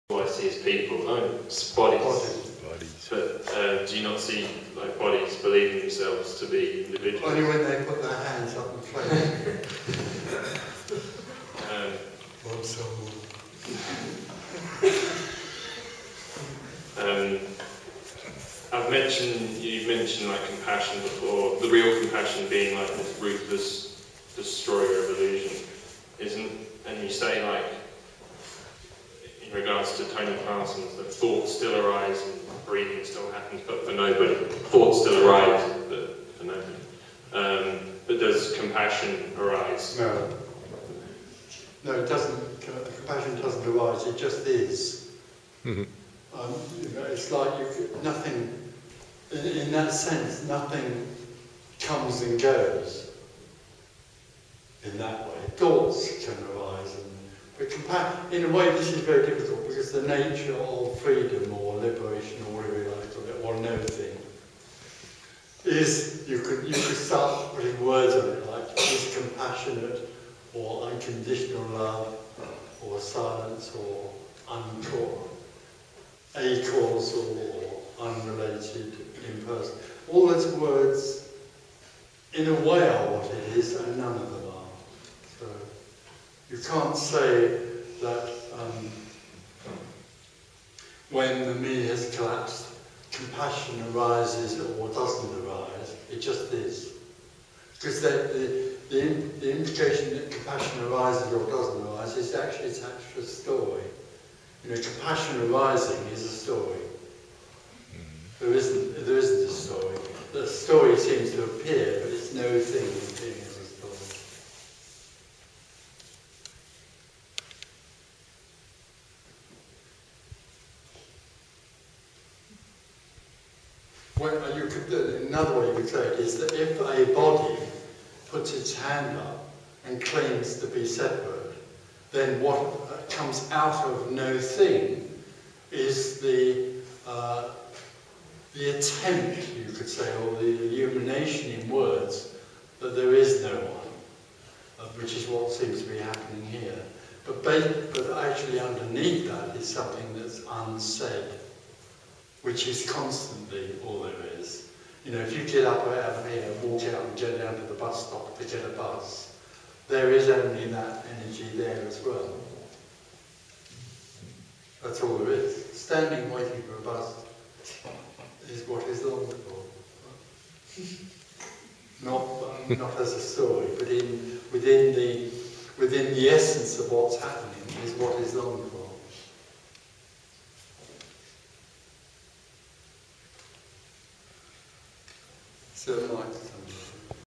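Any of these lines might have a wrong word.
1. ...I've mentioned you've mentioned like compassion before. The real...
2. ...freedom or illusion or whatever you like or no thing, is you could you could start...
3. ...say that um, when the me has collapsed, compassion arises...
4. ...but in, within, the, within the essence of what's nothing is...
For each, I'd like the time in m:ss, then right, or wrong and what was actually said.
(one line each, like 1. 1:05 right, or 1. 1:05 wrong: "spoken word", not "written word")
1. 0:18 right
2. 1:00 wrong: "liberation", not "illusion"
3. 1:26 right
4. 2:53 wrong: "happening", not "nothing".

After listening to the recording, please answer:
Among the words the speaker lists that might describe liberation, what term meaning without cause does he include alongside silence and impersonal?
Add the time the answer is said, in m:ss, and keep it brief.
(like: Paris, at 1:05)
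acausal, at 1:16.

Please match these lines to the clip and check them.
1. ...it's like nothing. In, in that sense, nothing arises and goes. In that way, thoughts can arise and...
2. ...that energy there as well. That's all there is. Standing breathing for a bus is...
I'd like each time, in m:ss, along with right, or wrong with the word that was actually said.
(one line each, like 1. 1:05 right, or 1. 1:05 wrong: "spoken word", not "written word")
1. 0:47 wrong: "comes", not "arises"
2. 2:40 wrong: "waiting", not "breathing".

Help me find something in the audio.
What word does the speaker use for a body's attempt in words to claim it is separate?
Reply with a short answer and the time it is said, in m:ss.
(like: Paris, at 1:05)
illumination, at 2:20.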